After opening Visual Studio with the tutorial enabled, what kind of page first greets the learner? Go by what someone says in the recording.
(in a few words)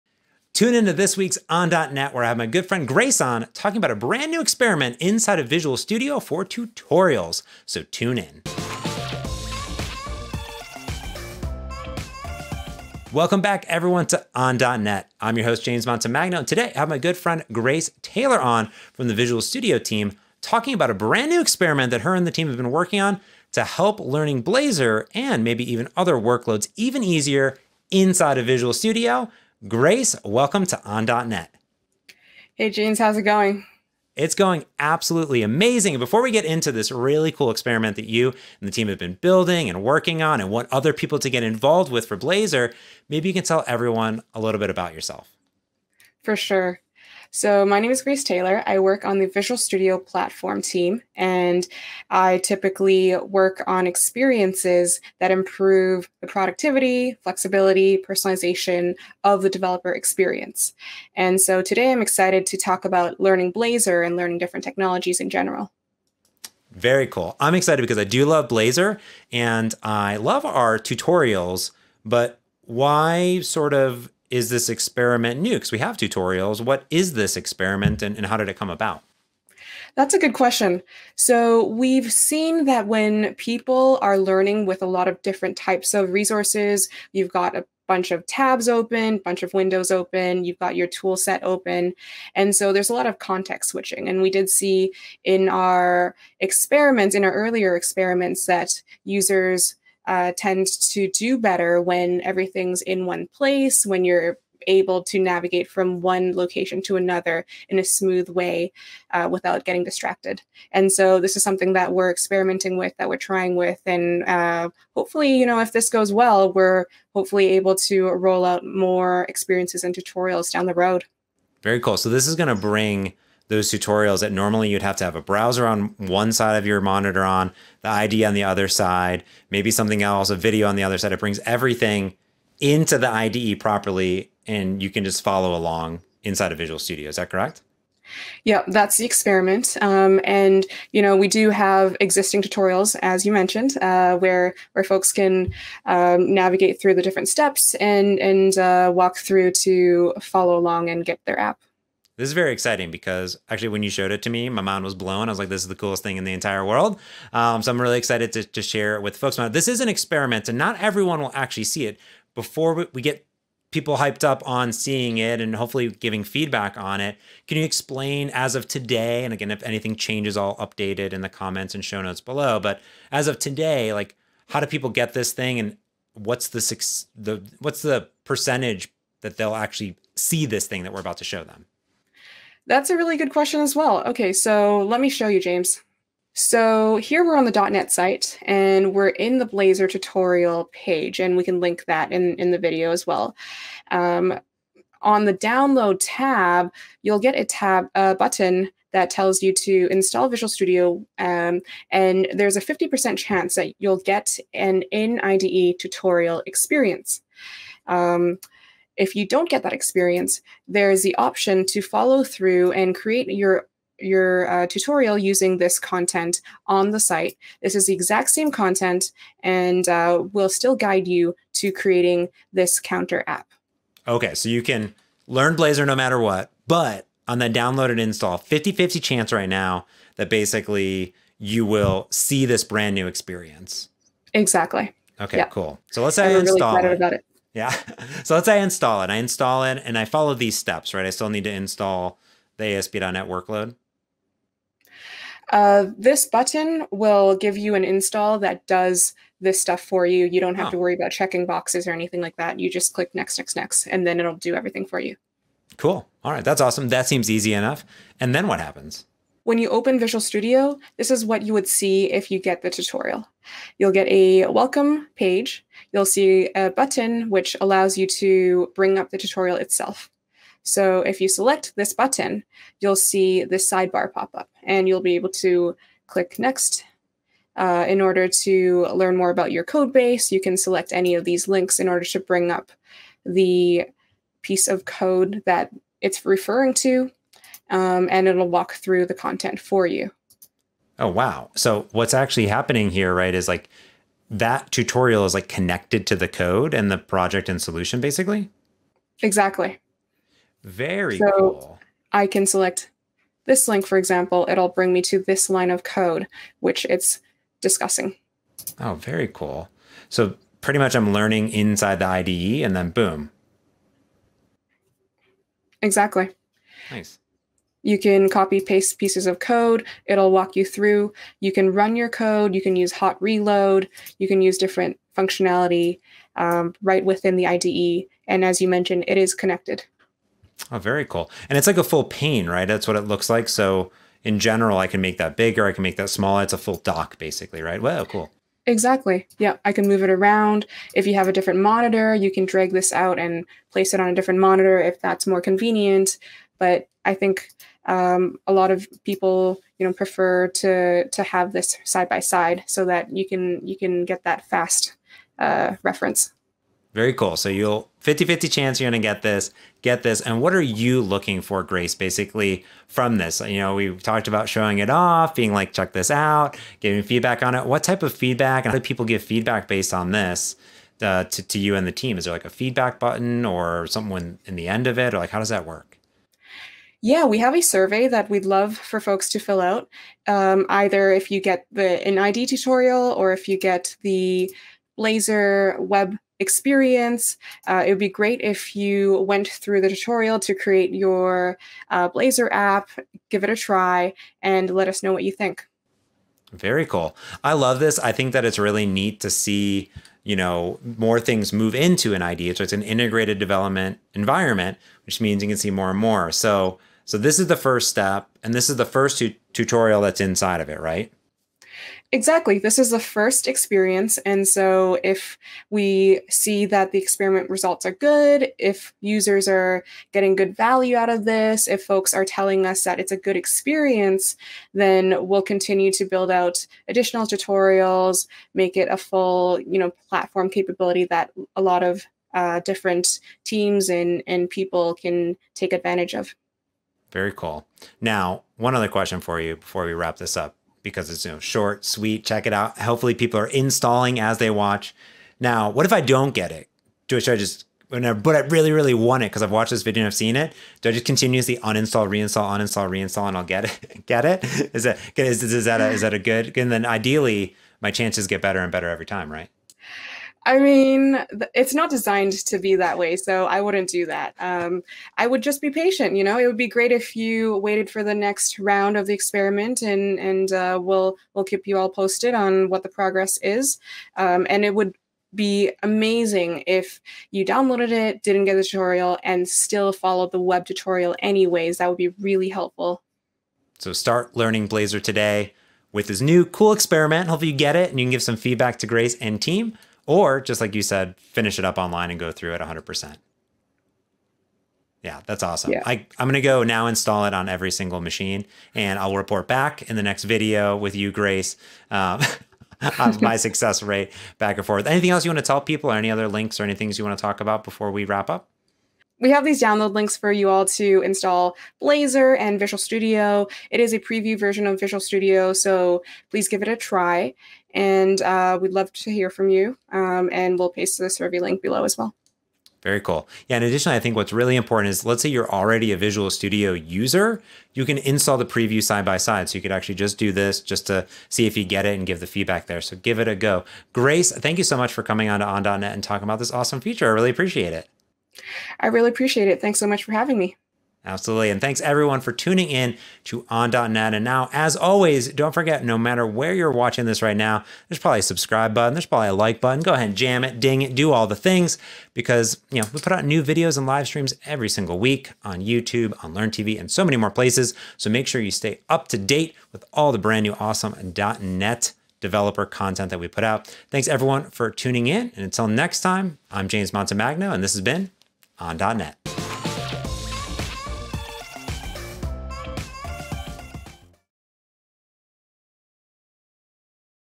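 welcome page.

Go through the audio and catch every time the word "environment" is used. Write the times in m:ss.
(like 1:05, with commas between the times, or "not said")
6:44.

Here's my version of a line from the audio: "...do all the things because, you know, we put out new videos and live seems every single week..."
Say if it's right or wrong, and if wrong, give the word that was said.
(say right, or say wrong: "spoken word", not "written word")
wrong: "streams", not "seems".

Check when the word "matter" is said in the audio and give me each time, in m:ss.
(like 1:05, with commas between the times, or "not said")
3:45, 9:05.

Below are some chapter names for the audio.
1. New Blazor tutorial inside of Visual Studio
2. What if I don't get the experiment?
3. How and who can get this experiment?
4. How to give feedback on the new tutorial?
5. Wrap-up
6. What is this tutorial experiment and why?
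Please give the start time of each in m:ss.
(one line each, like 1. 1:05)
1. 4:22
2. 7:25
3. 2:50
4. 6:08
5. 8:00
6. 1:15.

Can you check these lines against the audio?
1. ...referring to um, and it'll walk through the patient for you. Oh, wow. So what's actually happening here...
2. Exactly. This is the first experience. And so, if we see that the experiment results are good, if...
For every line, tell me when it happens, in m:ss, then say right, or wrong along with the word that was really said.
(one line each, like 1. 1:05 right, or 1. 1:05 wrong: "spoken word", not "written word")
1. 4:46 wrong: "content", not "patient"
2. 6:52 right.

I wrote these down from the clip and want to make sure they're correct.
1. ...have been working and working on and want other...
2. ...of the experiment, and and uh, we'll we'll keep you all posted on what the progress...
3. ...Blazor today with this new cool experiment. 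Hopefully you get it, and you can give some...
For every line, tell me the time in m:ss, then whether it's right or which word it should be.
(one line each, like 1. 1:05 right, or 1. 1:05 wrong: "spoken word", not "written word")
1. 0:38 wrong: "building", not "working"
2. 7:48 right
3. 8:04 right.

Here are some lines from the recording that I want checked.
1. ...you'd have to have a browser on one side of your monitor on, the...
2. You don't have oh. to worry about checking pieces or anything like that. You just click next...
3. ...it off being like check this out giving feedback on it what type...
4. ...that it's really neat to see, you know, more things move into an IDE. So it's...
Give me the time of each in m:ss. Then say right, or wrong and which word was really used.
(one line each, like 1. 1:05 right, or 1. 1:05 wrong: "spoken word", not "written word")
1. 2:04 right
2. 4:10 wrong: "boxes", not "pieces"
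3. 6:04 right
4. 6:38 right.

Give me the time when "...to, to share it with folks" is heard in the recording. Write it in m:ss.
2:38.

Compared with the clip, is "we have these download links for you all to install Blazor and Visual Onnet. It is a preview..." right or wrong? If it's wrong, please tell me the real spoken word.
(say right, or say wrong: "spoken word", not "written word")
wrong: "Studio", not "Onnet".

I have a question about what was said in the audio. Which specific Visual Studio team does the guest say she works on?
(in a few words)
Visual Studio platform team.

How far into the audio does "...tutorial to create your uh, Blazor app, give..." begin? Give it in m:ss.
6:29.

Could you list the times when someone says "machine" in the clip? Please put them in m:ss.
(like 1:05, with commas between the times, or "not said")
8:18.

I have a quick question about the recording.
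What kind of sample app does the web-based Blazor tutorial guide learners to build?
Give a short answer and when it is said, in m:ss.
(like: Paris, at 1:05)
counter app, at 3:42.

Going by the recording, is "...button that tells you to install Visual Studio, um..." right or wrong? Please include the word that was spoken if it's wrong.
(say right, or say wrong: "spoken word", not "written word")
right.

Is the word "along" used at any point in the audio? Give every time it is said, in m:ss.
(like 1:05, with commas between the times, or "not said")
2:15, 2:30.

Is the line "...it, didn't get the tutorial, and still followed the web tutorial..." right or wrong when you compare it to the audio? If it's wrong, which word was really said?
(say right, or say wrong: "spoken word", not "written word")
right.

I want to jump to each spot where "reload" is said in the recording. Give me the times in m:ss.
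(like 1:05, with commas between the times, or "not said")
5:23.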